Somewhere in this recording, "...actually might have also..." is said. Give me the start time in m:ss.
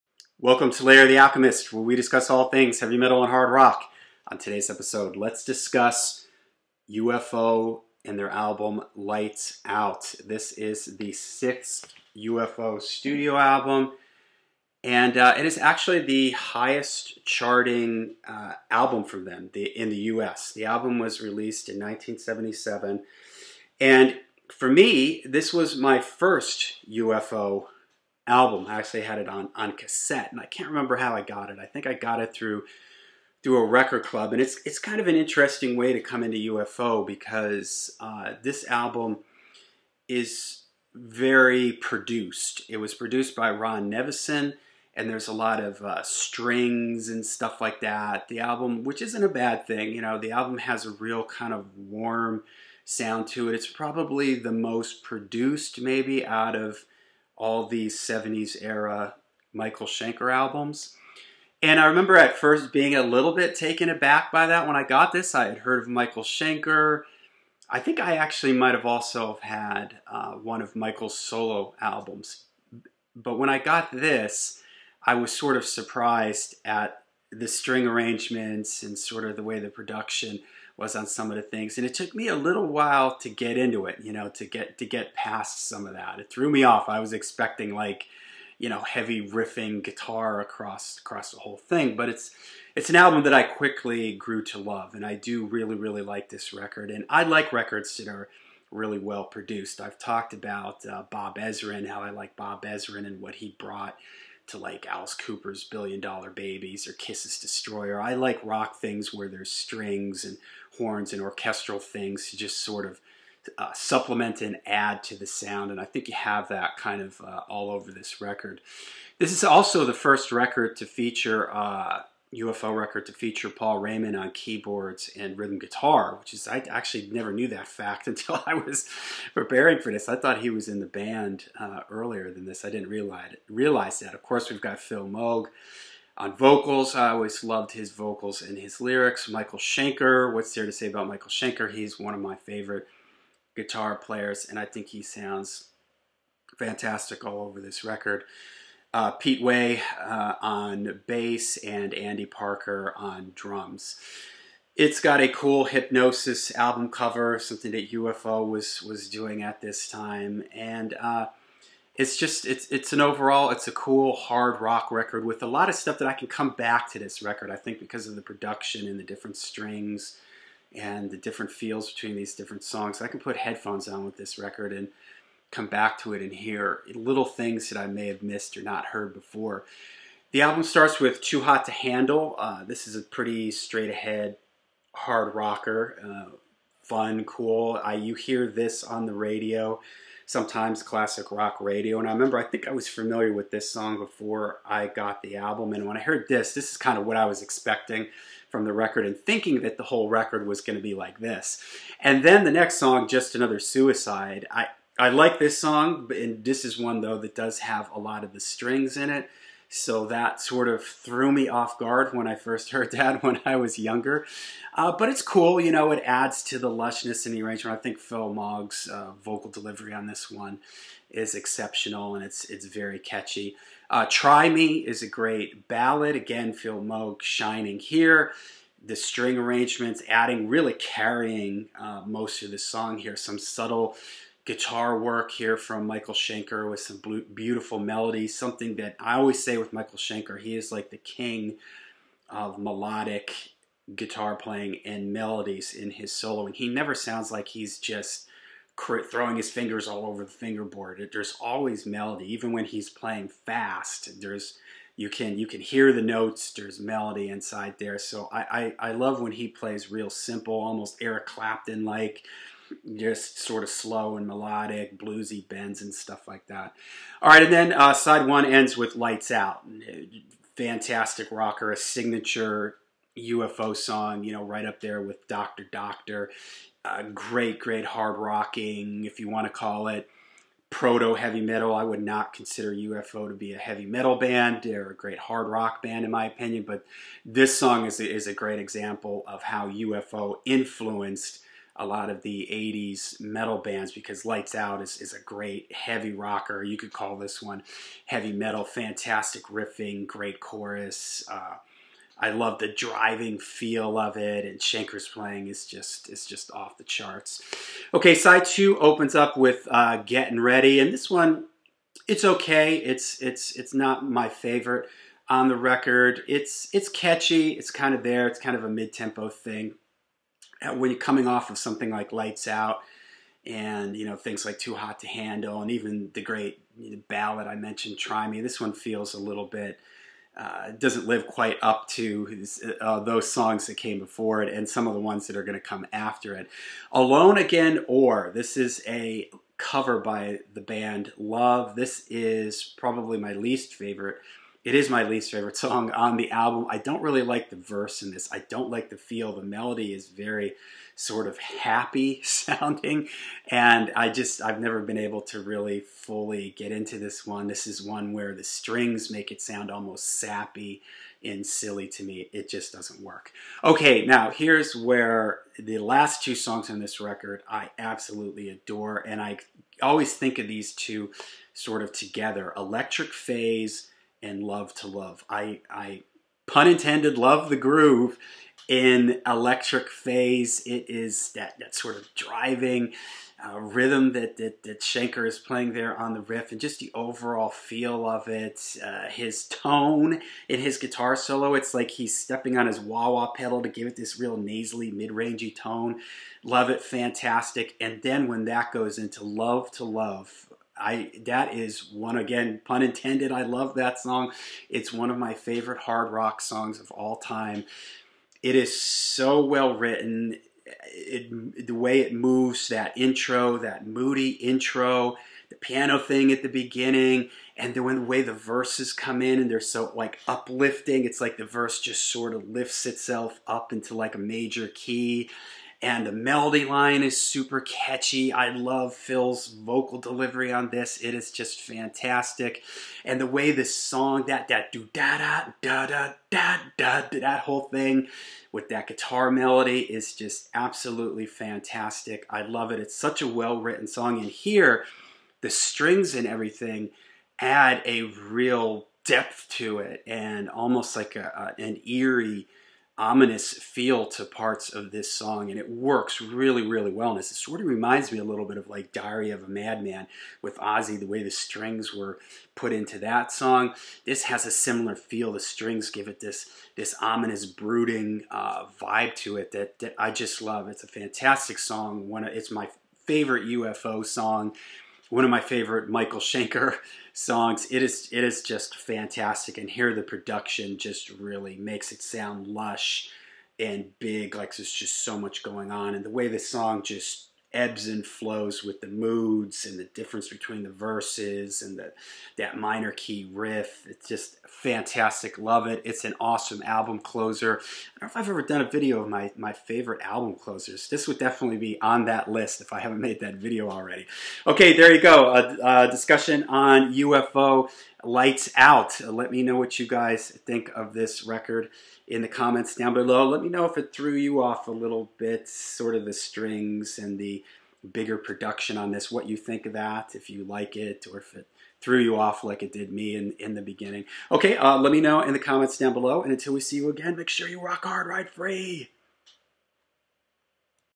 1:08.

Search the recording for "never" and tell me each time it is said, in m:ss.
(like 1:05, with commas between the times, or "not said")
2:07, 4:06, 5:54.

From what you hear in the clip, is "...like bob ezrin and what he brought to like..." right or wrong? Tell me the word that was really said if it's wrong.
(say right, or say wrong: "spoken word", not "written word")
right.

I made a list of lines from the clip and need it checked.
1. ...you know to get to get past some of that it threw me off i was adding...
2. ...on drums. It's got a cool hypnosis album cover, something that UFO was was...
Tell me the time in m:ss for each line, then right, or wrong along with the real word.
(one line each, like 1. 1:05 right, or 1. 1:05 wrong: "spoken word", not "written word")
1. 1:24 wrong: "expecting", not "adding"
2. 2:32 right.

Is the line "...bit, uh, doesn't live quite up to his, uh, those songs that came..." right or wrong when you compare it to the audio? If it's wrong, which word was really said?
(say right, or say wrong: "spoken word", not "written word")
right.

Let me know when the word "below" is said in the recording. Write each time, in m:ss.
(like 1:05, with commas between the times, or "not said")
8:32, 8:45.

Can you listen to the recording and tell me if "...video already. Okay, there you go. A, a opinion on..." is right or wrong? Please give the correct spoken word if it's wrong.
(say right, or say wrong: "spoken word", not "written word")
wrong: "discussion", not "opinion".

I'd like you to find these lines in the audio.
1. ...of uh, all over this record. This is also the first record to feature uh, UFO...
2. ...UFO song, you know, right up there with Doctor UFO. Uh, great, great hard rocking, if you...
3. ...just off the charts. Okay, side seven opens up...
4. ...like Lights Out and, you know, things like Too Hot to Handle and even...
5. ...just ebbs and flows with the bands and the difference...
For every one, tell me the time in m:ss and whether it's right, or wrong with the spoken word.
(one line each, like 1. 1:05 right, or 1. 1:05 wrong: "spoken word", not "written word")
1. 1:57 right
2. 4:33 wrong: "Doctor", not "UFO"
3. 5:06 wrong: "two", not "seven"
4. 5:21 right
5. 8:06 wrong: "moods", not "bands".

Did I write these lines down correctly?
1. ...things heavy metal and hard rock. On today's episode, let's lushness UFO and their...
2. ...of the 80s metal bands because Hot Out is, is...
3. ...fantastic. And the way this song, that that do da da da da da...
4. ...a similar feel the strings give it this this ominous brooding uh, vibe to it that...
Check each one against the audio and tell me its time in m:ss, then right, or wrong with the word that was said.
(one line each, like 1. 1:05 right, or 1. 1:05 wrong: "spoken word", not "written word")
1. 0:02 wrong: "discuss", not "lushness"
2. 4:52 wrong: "Lights", not "Hot"
3. 7:11 right
4. 7:44 right.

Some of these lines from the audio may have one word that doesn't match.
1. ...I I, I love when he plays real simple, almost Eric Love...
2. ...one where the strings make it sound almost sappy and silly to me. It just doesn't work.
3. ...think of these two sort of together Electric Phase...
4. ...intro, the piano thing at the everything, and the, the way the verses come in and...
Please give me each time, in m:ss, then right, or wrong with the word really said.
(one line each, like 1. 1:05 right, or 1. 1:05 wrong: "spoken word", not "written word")
1. 4:18 wrong: "Clapton", not "Love"
2. 5:57 right
3. 6:10 right
4. 6:54 wrong: "beginning", not "everything".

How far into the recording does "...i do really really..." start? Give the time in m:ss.
1:35.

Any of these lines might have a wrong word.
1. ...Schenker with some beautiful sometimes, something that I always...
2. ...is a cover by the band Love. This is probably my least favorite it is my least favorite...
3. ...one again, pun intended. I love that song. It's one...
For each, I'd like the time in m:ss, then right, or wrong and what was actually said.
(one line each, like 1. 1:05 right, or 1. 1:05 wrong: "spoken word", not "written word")
1. 3:56 wrong: "melodies", not "sometimes"
2. 5:38 right
3. 6:41 right.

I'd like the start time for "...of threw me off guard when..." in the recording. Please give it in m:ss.
3:30.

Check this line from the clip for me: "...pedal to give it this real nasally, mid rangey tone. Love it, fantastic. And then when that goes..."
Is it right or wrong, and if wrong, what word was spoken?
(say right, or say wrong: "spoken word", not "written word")
right.